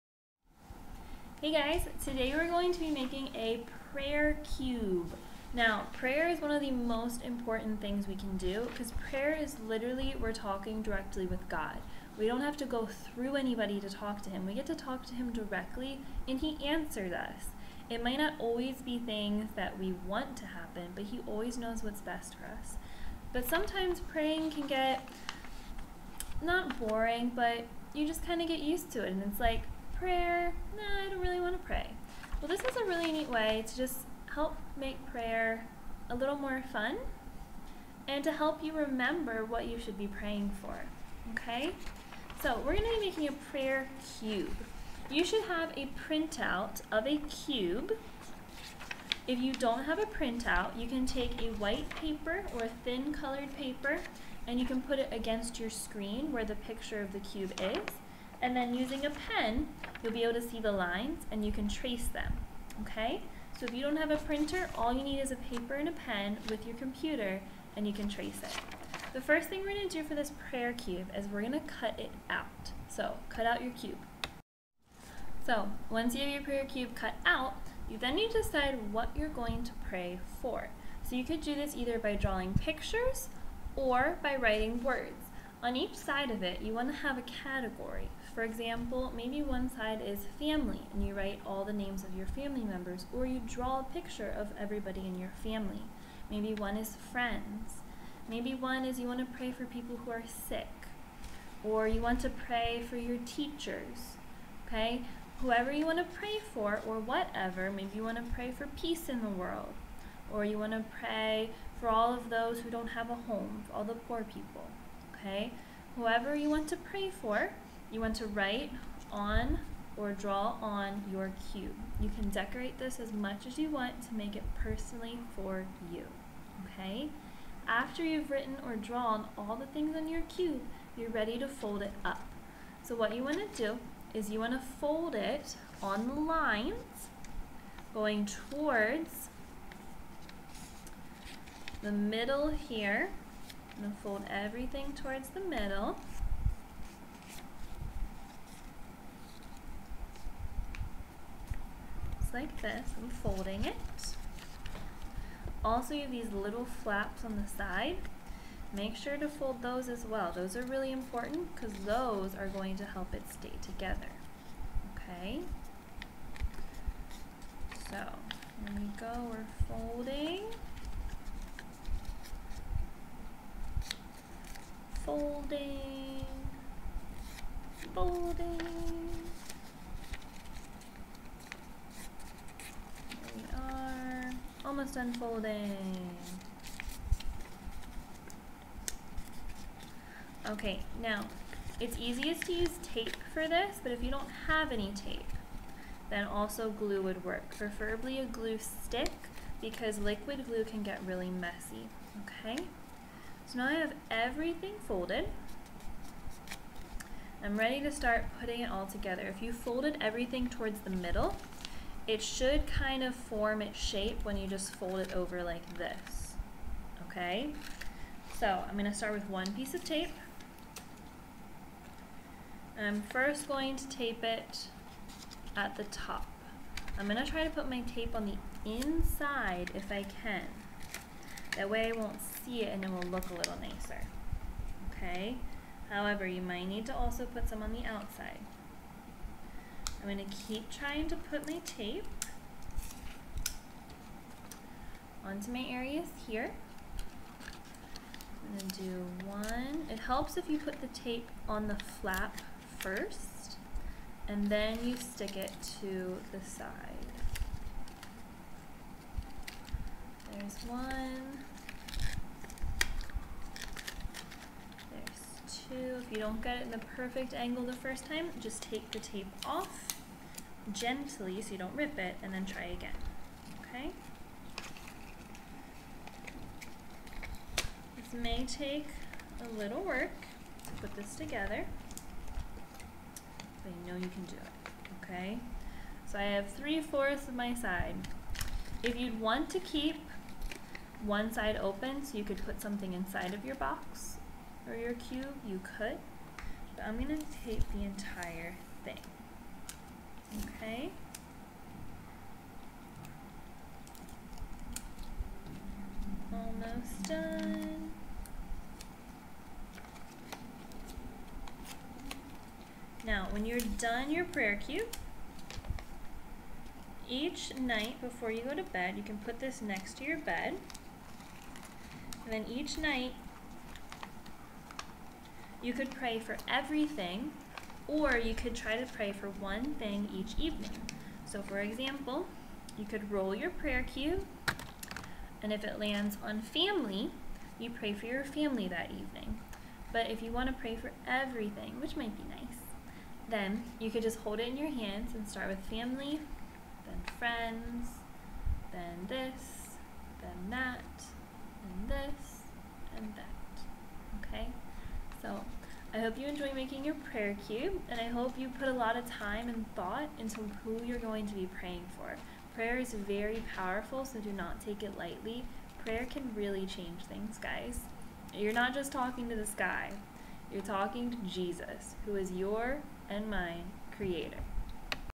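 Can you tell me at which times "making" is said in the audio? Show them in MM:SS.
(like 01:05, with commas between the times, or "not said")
00:02, 00:43, 05:56.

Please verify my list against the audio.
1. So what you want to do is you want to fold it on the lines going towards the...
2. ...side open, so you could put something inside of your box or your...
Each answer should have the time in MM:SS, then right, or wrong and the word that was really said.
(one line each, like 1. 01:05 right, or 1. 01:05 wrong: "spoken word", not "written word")
1. 02:12 right
2. 04:51 right.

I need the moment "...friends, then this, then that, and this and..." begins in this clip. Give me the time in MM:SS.
05:47.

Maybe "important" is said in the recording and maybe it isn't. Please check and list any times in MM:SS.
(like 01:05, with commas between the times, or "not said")
00:07, 02:40.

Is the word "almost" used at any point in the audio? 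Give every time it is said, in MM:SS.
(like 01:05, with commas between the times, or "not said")
03:04, 05:06.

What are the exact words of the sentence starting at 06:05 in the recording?
Prayer can really change things, guys.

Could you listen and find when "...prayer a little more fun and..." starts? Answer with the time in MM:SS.
00:35.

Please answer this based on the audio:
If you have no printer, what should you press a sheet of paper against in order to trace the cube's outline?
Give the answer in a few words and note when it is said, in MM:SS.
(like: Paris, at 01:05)
Your screen, at 00:55.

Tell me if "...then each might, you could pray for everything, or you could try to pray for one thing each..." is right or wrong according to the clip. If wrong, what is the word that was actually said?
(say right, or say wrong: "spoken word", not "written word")
wrong: "night", not "might".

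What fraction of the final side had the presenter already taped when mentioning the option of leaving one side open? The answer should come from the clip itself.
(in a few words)
3/4.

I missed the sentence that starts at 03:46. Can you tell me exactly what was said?
I'm gonna try to put my tape on the inside if I can.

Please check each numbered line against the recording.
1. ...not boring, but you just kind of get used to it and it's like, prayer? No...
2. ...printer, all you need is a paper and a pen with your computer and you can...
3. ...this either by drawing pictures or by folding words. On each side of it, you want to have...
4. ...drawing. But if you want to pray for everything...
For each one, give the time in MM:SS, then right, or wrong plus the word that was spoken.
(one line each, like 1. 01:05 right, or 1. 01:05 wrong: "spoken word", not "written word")
1. 00:26 right
2. 01:04 right
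3. 01:21 wrong: "writing", not "folding"
4. 05:38 wrong: "evening", not "drawing".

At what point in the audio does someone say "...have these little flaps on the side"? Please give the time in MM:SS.
02:36.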